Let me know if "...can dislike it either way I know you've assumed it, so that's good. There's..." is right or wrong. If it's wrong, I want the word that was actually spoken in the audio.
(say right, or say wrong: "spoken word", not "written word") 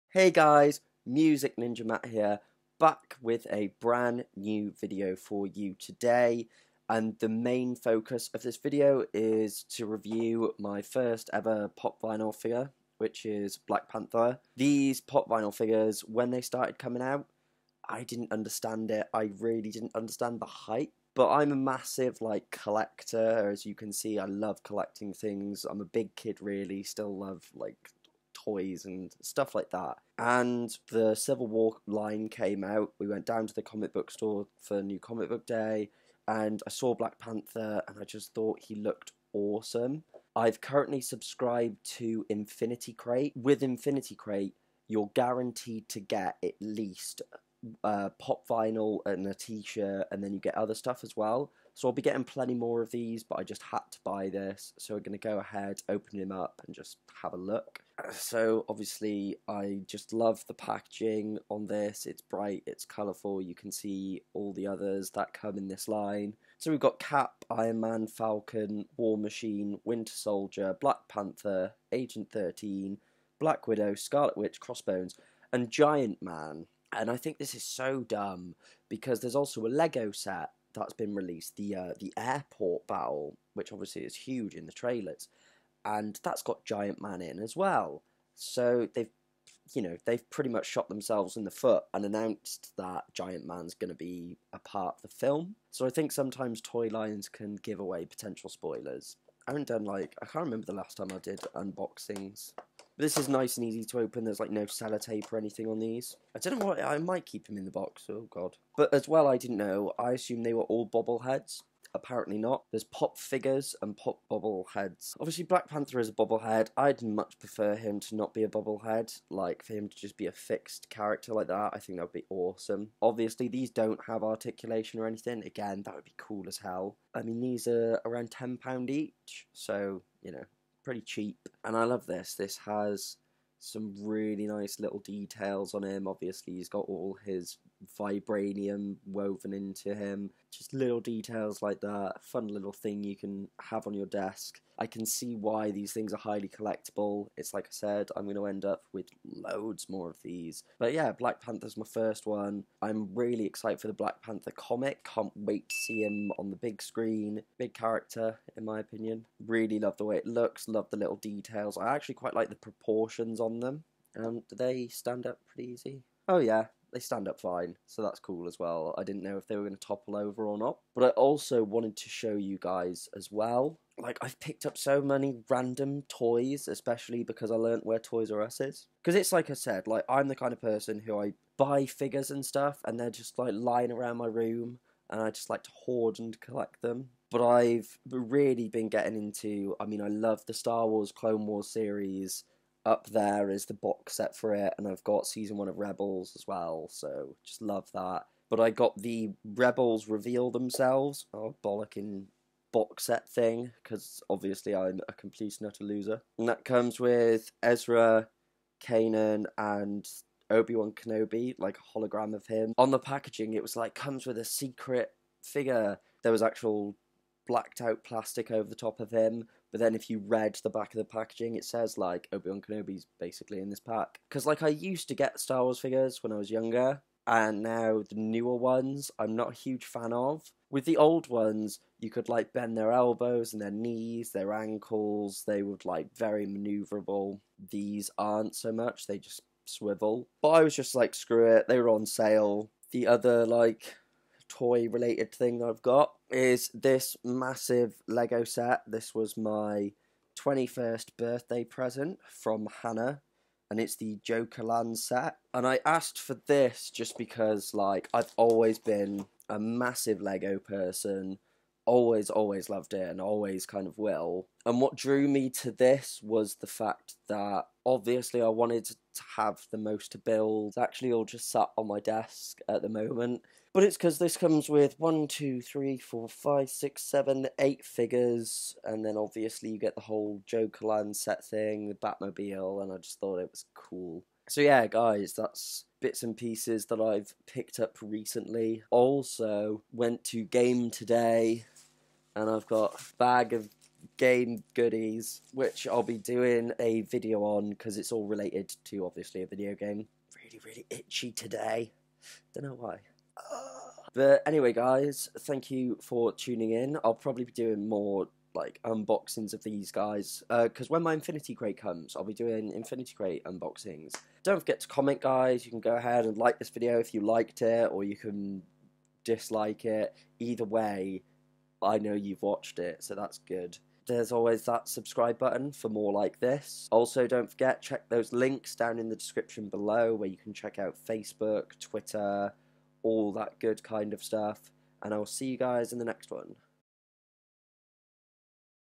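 wrong: "watched", not "assumed".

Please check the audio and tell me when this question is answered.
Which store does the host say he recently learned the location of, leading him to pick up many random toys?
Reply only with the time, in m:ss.
2:57.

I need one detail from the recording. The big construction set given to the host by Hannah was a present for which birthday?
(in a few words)
21st.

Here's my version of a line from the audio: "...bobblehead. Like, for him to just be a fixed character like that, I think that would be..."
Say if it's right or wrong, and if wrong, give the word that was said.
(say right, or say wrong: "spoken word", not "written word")
right.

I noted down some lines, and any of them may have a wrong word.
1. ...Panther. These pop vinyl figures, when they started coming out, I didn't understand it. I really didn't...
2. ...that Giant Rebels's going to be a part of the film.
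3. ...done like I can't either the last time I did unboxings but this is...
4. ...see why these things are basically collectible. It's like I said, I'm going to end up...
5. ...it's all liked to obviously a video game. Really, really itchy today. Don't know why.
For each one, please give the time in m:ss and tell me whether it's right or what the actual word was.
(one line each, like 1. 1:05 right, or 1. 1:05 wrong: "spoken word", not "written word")
1. 0:13 right
2. 1:32 wrong: "Man", not "Rebels"
3. 1:39 wrong: "remember", not "either"
4. 2:25 wrong: "highly", not "basically"
5. 4:57 wrong: "related", not "liked".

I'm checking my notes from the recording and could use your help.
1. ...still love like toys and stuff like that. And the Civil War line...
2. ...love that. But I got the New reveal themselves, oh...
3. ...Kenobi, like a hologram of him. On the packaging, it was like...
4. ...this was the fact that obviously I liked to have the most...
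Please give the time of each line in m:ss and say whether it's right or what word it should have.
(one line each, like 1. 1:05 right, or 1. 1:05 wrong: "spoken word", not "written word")
1. 0:26 right
2. 3:17 wrong: "Rebels", not "New"
3. 3:30 right
4. 4:25 wrong: "wanted", not "liked".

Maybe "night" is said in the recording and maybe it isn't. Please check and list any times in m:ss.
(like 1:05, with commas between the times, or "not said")
not said.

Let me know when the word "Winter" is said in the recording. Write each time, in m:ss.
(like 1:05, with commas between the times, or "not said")
1:09.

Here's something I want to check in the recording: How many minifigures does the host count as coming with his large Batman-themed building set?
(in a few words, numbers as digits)
8.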